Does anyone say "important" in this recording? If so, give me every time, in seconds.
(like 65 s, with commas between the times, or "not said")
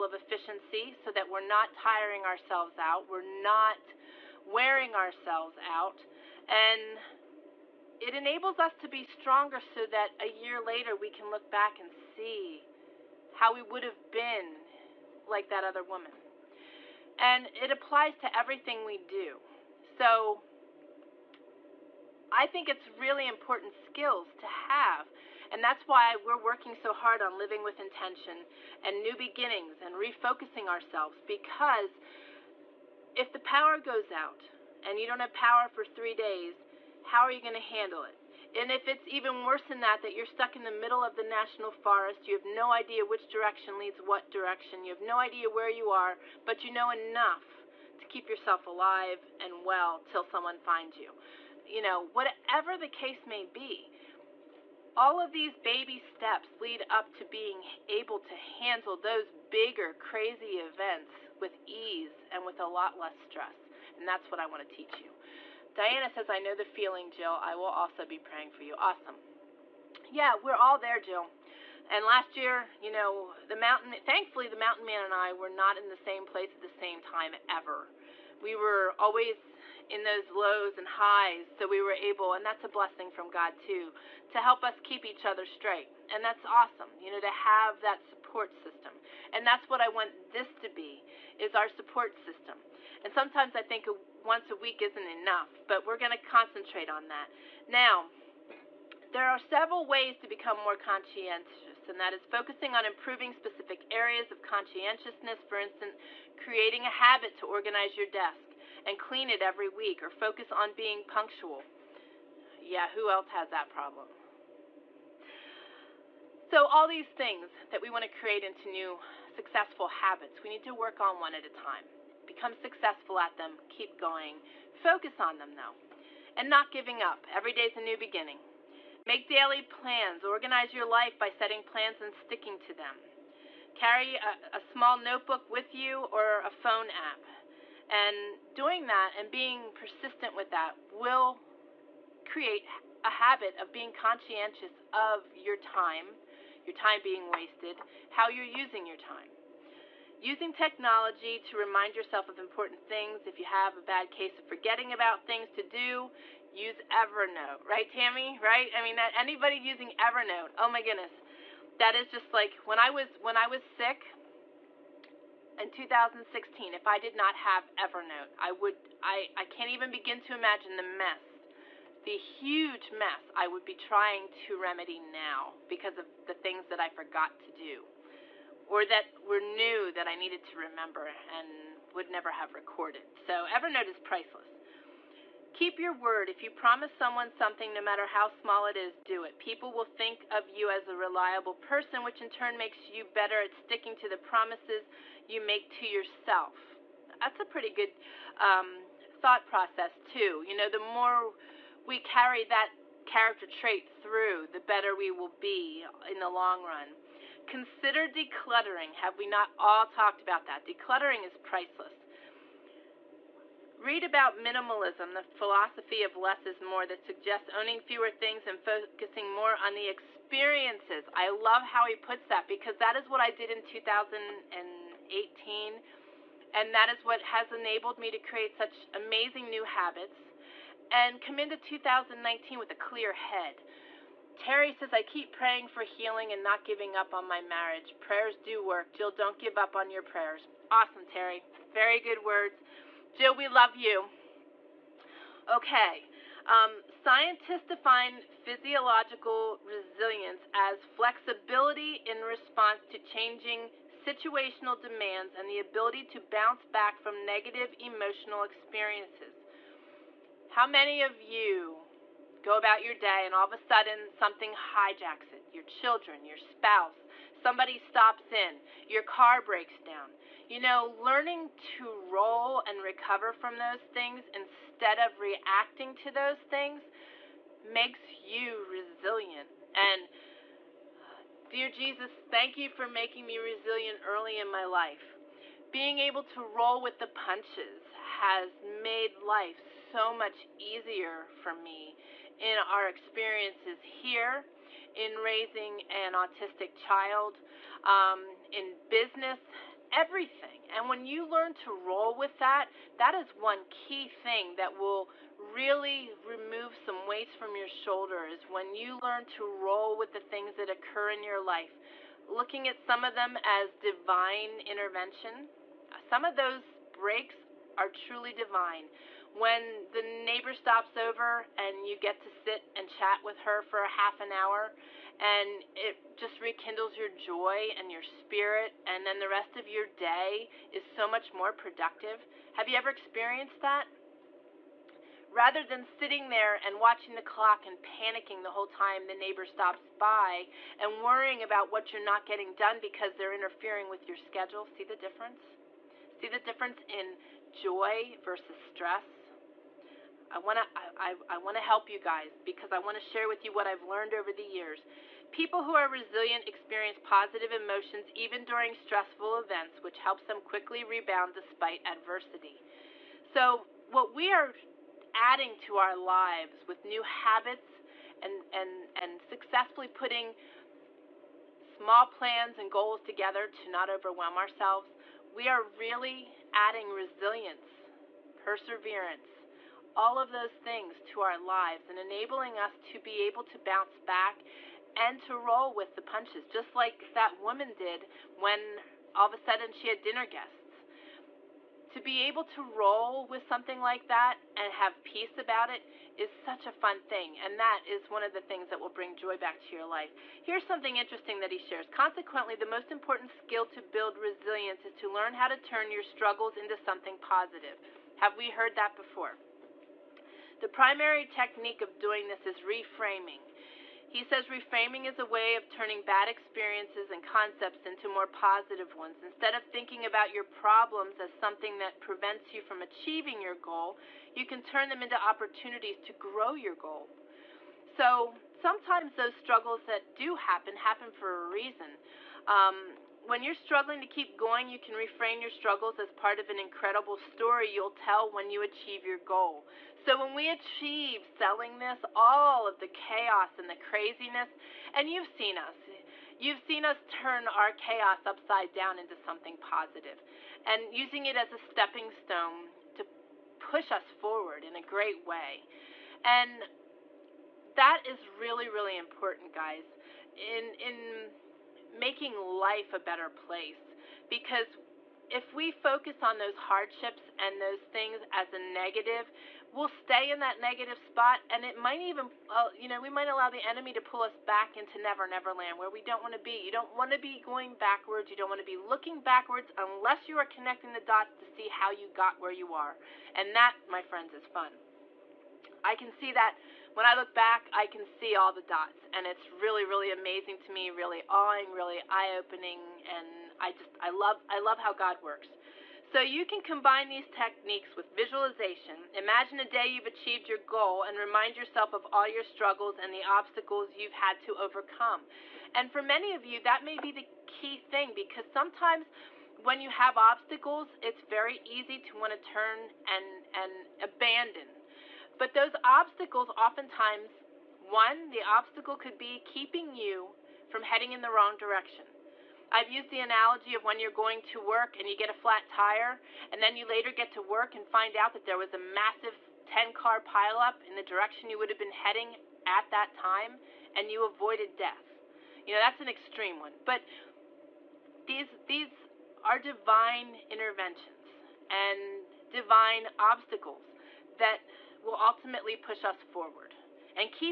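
23 s, 152 s, 402 s, 458 s.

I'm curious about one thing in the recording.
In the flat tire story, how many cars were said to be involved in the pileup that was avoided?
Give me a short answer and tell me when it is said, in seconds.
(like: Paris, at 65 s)
10, at 529 s.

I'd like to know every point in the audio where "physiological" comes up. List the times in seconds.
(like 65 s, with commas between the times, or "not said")
248 s.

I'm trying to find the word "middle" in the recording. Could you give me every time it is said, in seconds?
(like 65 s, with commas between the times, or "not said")
40 s.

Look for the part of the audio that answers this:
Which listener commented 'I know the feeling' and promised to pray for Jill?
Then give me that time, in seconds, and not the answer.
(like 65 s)
65 s.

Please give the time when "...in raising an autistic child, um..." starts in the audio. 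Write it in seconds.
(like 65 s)
294 s.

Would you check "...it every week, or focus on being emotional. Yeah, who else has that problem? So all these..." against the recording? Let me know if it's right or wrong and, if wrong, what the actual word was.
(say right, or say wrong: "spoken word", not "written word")
wrong: "punctual", not "emotional".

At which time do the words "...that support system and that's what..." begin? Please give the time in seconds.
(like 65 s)
87 s.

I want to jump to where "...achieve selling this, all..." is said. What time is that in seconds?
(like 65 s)
440 s.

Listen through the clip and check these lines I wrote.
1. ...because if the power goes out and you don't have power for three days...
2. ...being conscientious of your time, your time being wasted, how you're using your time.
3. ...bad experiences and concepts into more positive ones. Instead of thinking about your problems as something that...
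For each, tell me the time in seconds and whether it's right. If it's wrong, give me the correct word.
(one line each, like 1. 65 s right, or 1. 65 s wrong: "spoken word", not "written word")
1. 31 s right
2. 143 s right
3. 415 s right.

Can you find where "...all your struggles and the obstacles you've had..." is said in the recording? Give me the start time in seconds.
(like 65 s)
502 s.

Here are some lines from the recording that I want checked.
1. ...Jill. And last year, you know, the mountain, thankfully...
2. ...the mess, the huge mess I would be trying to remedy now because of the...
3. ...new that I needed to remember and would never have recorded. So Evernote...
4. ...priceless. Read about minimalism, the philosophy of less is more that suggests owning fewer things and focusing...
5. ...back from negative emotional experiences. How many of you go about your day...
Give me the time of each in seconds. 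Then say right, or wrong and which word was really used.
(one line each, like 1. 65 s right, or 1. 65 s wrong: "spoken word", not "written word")
1. 70 s right
2. 170 s right
3. 179 s right
4. 211 s right
5. 256 s right.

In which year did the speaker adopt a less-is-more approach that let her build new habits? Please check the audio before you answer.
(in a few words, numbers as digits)
2018.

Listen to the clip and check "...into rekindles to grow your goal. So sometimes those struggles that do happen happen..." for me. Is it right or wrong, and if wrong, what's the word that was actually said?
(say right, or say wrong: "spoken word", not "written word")
wrong: "opportunities", not "rekindles".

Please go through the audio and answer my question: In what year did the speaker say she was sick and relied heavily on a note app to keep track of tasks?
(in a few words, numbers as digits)
2016.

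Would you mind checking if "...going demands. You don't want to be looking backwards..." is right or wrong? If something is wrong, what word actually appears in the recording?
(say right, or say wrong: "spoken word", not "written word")
wrong: "backwards", not "demands".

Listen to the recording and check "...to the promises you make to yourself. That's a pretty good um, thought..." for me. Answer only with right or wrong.
right.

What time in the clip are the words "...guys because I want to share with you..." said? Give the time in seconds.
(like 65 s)
351 s.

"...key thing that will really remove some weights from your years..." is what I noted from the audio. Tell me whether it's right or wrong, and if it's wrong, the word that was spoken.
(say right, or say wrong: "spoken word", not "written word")
wrong: "shoulders", not "years".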